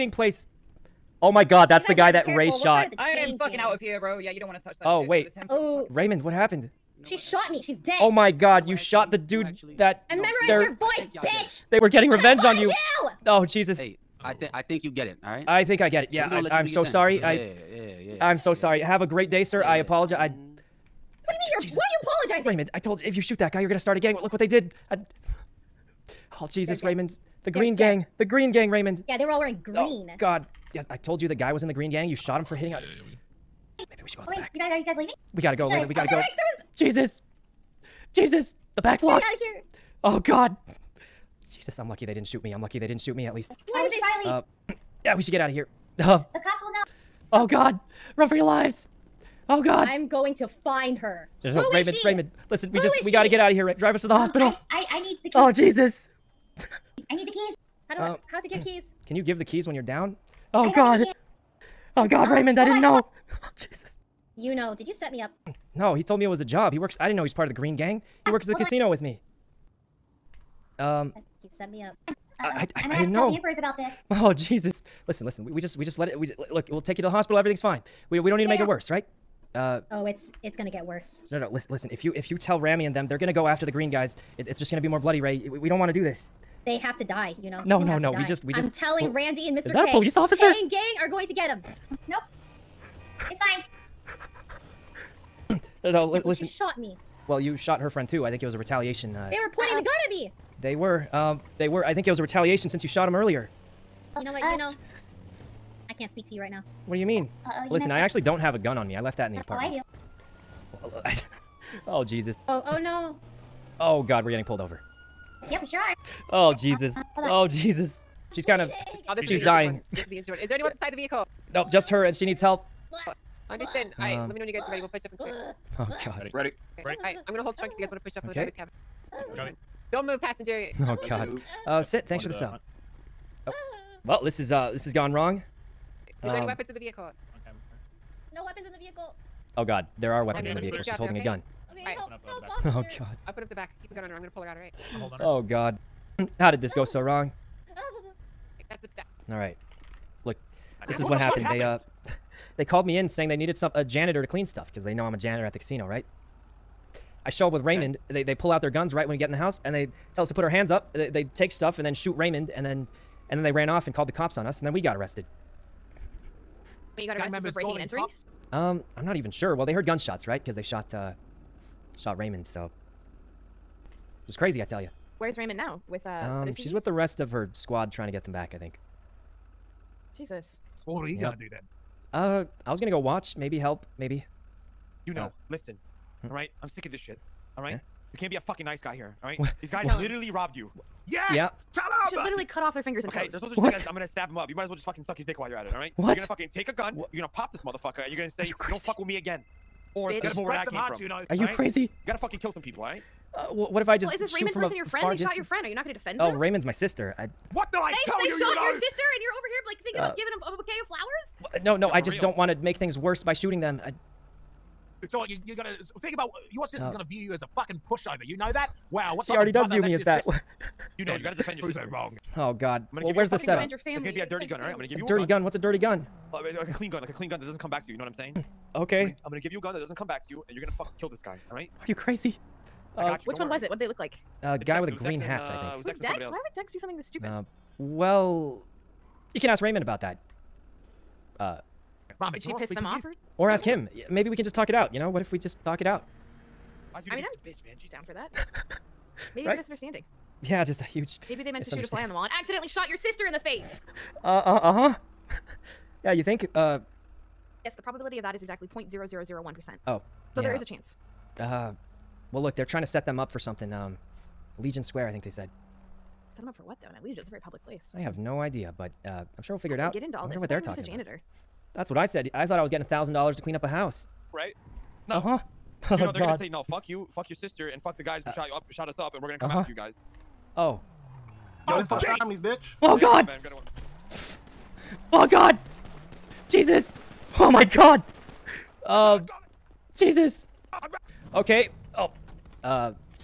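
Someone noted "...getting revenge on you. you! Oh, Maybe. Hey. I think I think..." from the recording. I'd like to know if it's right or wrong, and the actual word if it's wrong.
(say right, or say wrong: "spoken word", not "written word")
wrong: "Jesus", not "Maybe".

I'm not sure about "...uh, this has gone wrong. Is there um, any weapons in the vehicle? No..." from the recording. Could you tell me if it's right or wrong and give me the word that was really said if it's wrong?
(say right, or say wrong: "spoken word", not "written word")
right.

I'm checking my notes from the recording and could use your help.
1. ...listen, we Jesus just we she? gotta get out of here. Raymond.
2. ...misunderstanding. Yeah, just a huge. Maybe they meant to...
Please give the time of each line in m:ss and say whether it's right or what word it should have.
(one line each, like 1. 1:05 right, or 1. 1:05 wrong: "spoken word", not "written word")
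1. 0:52 wrong: "Who", not "Jesus"
2. 4:09 right.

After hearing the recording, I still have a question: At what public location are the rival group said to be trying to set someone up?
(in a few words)
Legion Square.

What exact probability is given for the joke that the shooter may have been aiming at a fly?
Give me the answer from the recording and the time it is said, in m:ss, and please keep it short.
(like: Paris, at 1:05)
0.0001%, at 4:18.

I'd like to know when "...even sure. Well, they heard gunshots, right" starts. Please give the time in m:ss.
2:49.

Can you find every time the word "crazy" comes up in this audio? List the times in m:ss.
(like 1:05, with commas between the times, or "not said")
2:54, 3:21, 3:51.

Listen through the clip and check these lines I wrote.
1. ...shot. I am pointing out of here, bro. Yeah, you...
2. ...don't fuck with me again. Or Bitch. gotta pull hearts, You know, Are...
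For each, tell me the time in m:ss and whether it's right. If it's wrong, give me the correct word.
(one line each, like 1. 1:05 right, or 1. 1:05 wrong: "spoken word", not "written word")
1. 0:02 wrong: "fucking", not "pointing"
2. 3:18 right.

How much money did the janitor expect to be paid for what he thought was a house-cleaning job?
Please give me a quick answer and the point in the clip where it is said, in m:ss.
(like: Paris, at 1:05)
$1,000, at 4:32.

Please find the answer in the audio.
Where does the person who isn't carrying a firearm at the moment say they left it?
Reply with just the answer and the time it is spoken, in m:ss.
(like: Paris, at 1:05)
the apartment, at 1:49.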